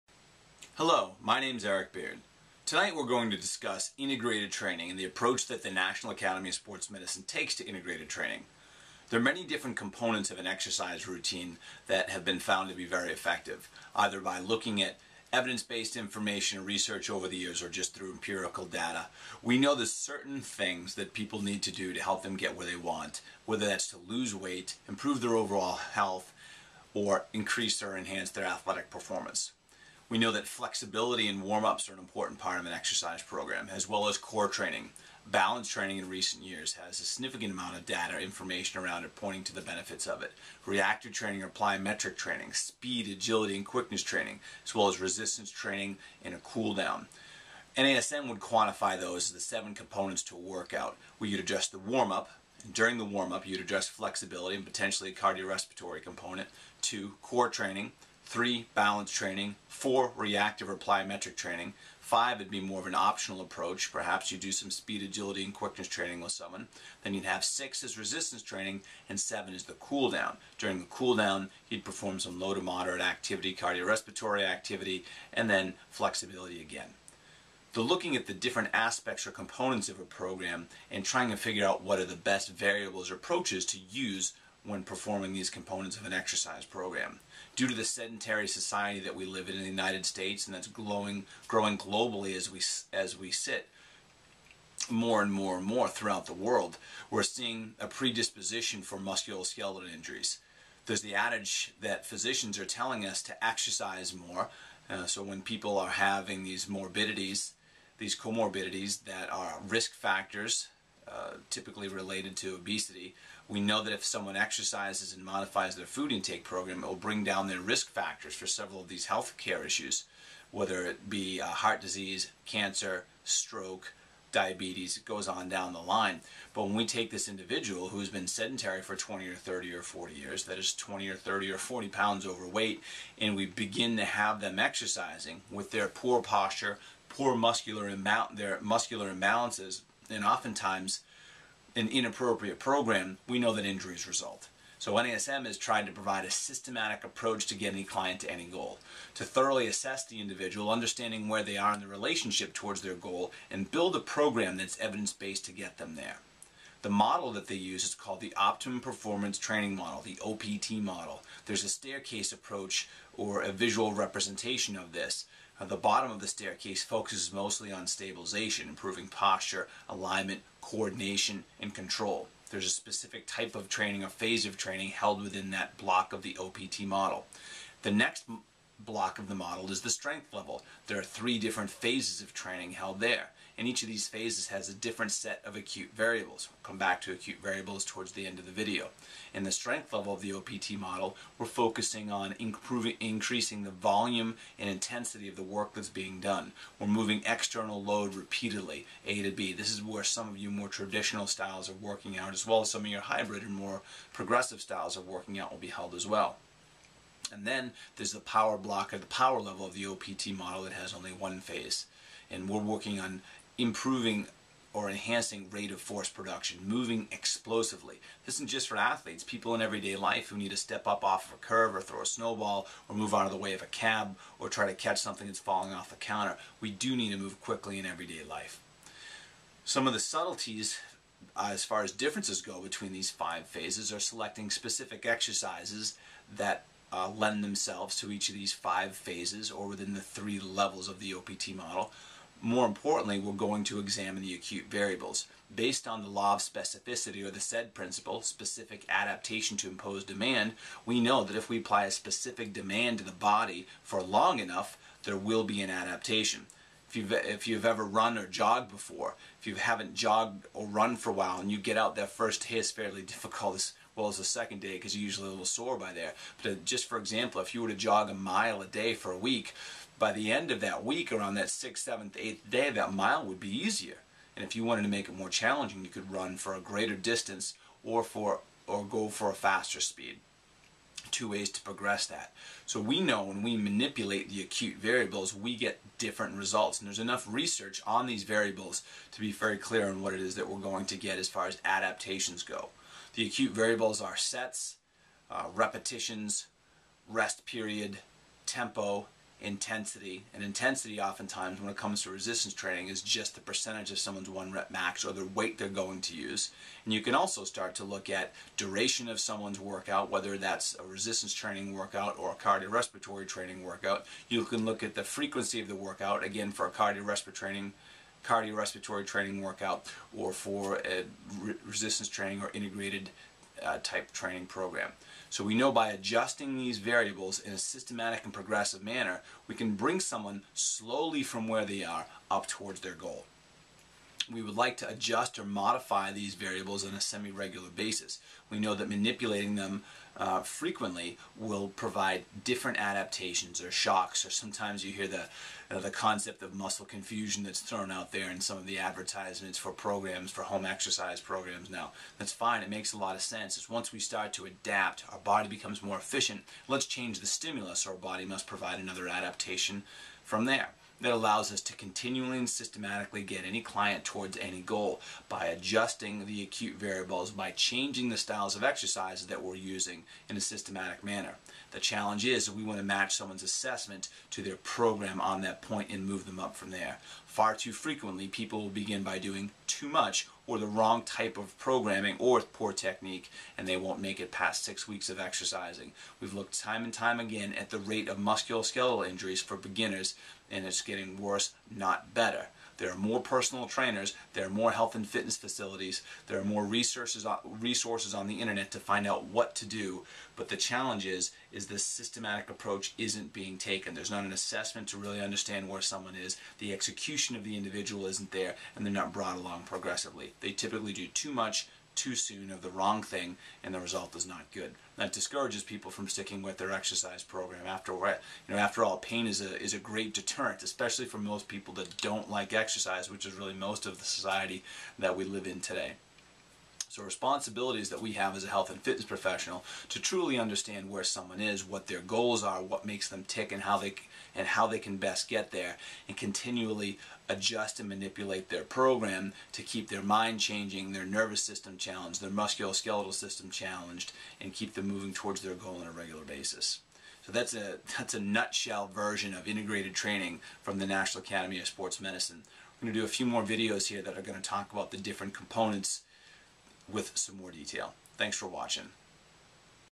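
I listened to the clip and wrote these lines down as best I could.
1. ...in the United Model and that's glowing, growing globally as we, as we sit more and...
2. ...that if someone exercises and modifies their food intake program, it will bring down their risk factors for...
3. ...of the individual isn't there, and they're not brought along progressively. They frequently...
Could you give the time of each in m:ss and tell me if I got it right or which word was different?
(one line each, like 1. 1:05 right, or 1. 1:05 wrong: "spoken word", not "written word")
1. 1:29 wrong: "States", not "Model"
2. 1:53 right
3. 6:47 wrong: "typically", not "frequently".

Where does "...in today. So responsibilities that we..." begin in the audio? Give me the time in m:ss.
7:05.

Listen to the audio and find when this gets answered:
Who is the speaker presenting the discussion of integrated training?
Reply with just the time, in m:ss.
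0:01.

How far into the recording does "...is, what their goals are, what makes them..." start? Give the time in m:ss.
7:11.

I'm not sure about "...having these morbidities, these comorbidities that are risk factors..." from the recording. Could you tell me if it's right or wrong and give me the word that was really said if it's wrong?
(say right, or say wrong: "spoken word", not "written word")
right.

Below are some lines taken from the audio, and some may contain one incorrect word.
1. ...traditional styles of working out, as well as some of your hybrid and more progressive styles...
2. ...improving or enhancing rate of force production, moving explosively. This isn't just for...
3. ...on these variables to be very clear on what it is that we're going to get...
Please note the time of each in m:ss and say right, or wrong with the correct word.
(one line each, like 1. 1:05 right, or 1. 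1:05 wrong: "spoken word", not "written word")
1. 3:20 right
2. 3:33 right
3. 4:47 right.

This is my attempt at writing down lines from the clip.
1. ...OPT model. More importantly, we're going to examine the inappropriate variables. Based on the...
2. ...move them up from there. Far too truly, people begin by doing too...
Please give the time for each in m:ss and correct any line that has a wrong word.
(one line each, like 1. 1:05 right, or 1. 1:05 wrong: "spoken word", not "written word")
1. 4:01 wrong: "acute", not "inappropriate"
2. 6:16 wrong: "frequently", not "truly".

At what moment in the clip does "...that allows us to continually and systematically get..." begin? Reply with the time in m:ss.
6:01.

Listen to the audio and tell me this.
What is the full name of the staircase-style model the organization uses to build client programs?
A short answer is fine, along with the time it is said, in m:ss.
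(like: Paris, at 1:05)
Optimum Performance Training Model, at 2:38.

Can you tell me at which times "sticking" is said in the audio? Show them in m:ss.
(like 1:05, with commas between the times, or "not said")
6:56.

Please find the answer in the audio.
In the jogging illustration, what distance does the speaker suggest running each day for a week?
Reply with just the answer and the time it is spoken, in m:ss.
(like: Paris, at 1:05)
a mile, at 4:28.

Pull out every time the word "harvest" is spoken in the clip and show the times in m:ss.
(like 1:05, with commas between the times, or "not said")
not said.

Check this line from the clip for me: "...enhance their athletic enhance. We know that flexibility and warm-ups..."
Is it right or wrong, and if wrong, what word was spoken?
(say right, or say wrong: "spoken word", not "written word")
wrong: "performance", not "enhance".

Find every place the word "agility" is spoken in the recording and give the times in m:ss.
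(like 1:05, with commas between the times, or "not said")
0:43, 1:05.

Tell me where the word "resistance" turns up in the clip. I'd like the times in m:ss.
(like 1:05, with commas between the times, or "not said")
0:44, 1:07, 5:02, 5:10, 5:21.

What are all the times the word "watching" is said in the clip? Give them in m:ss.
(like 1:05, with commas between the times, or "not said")
7:38.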